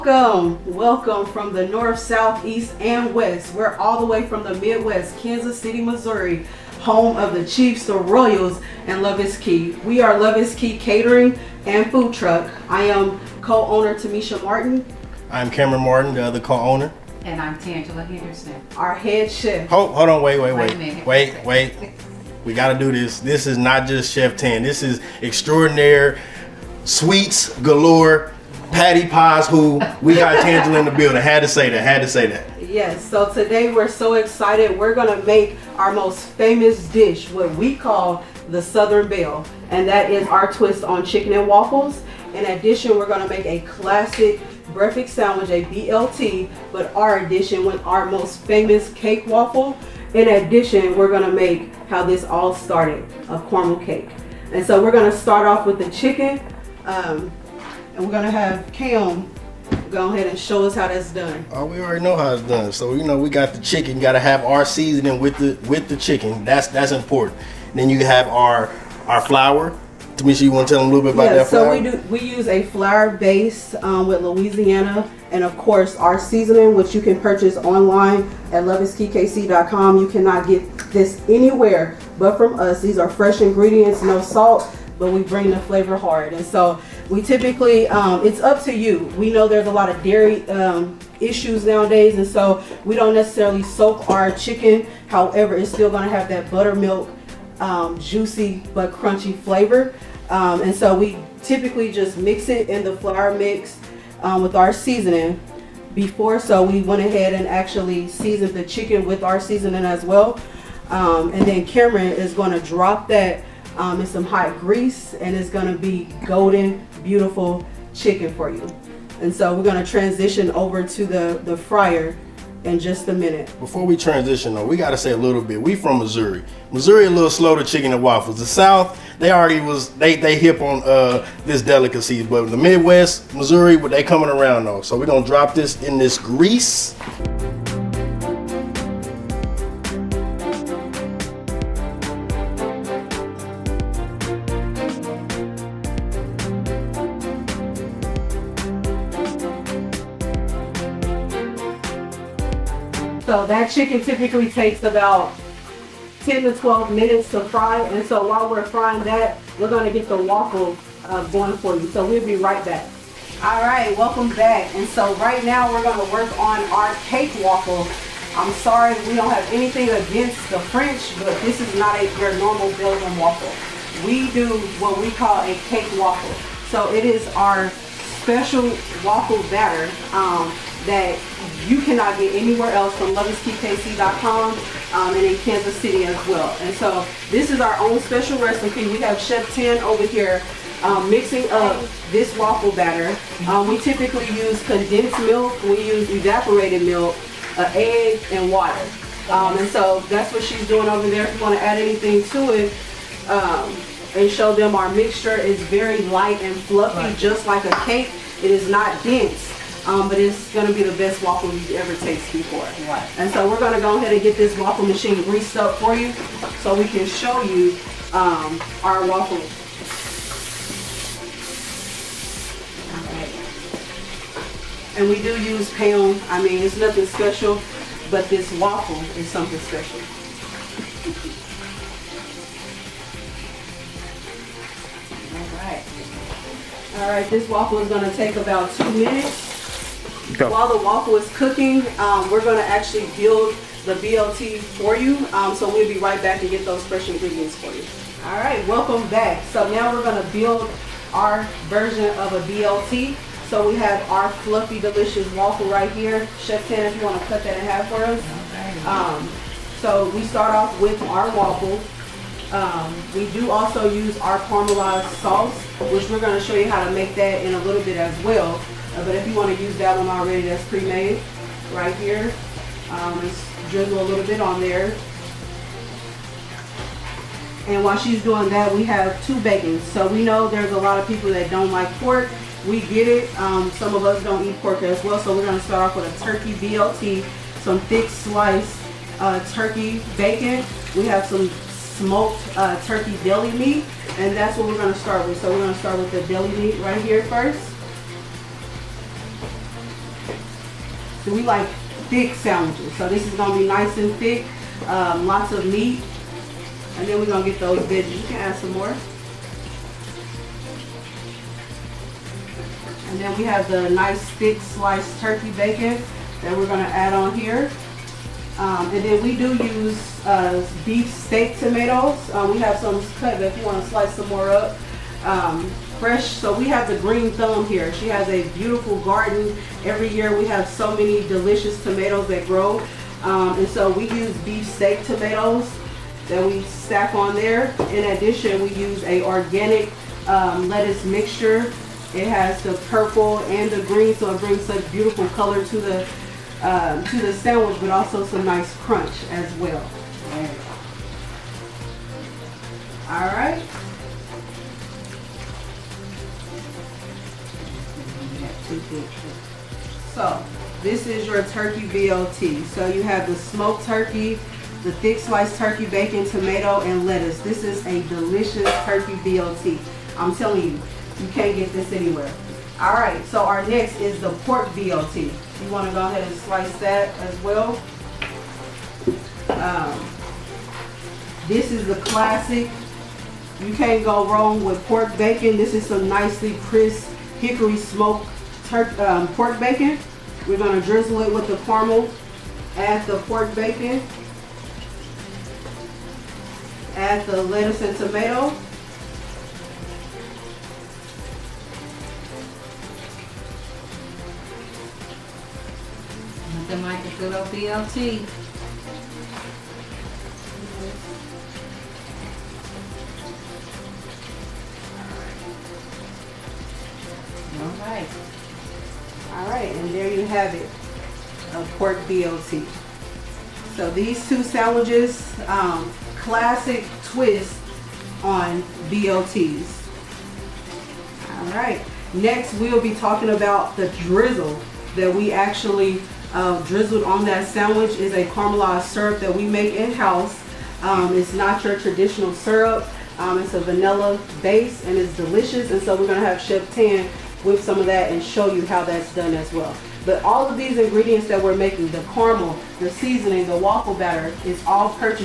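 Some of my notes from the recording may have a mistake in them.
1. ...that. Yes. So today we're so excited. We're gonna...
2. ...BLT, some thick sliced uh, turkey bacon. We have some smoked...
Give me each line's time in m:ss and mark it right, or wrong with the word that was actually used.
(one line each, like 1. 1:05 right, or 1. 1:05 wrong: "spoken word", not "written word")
1. 0:32 right
2. 4:46 right.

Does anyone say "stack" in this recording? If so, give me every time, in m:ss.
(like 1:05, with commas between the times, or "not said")
5:36.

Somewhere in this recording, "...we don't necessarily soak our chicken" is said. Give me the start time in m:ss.
1:32.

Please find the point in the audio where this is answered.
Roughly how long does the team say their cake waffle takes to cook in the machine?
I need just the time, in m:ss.
3:58.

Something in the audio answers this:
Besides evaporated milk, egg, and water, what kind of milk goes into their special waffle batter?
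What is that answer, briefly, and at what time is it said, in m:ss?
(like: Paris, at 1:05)
Condensed milk, at 3:14.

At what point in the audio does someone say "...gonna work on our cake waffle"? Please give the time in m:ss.
2:45.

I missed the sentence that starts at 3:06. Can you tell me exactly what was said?
And so this is our own special recipe.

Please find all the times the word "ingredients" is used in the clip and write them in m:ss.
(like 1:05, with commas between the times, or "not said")
1:23, 4:07, 7:30.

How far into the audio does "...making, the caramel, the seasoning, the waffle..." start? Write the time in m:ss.
7:31.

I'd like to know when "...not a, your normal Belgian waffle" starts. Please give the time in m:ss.
2:51.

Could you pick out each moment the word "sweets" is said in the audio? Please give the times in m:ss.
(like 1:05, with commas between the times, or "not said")
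0:26.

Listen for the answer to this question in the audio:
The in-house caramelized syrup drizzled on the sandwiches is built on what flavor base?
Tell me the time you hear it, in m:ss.
7:23.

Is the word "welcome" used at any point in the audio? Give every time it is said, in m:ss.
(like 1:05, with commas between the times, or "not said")
0:00, 2:43, 4:08.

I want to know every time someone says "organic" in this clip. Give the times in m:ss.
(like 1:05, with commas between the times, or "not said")
5:39.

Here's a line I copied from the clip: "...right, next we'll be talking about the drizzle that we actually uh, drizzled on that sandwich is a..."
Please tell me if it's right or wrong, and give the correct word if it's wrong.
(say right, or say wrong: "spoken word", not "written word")
right.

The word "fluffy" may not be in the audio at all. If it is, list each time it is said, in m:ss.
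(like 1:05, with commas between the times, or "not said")
3:26, 4:14.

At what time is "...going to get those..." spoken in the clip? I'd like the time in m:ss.
5:07.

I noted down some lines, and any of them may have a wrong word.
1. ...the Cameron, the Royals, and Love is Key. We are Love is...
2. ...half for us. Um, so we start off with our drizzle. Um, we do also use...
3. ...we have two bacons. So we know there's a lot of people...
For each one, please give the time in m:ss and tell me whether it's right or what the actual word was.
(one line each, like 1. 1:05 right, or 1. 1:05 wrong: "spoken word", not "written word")
1. 0:07 wrong: "Chiefs", not "Cameron"
2. 4:17 wrong: "waffle", not "drizzle"
3. 4:38 right.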